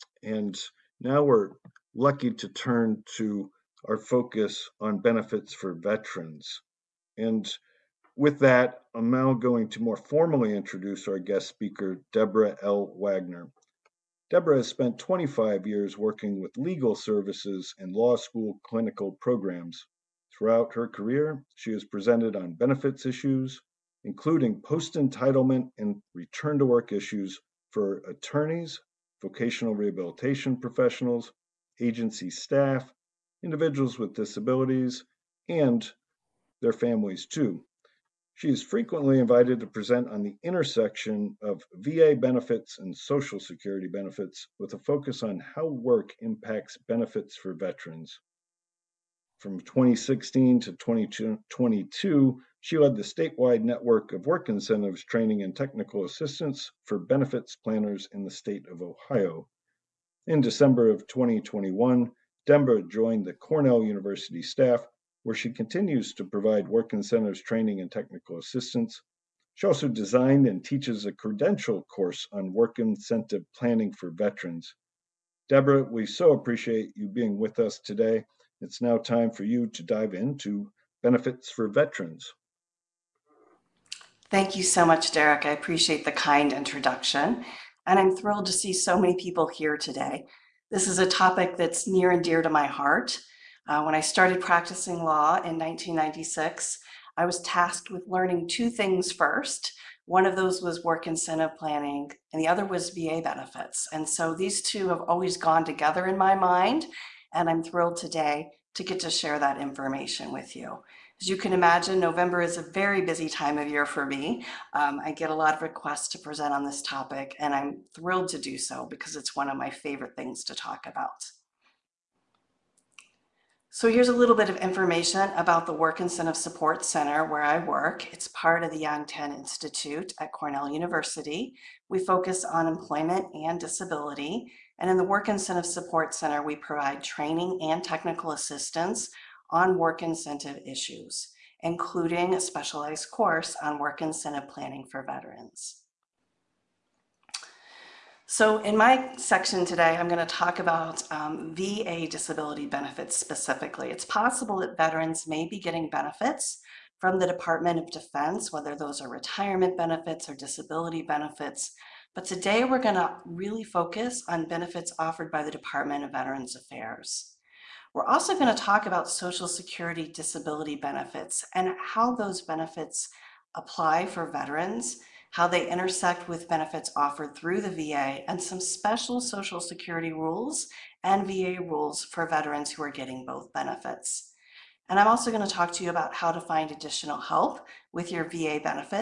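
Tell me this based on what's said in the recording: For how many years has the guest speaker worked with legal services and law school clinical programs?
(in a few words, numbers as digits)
25.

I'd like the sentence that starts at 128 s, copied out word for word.
It's part of the Yang-Tan Institute at Cornell University.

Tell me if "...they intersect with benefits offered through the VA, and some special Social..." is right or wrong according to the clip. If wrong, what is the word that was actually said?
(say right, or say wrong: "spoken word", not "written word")
right.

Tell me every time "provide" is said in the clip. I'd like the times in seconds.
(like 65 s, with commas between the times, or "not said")
66 s, 136 s.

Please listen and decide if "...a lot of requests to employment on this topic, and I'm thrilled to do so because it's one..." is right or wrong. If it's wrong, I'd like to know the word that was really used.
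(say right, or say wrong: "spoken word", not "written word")
wrong: "present", not "employment".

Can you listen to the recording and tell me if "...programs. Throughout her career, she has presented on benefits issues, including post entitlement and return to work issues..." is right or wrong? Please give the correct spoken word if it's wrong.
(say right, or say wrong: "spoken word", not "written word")
right.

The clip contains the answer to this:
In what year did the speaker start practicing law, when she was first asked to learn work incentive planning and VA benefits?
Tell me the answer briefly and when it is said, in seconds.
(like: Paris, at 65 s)
1996, at 95 s.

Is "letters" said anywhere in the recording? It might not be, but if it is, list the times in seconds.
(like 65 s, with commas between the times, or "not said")
not said.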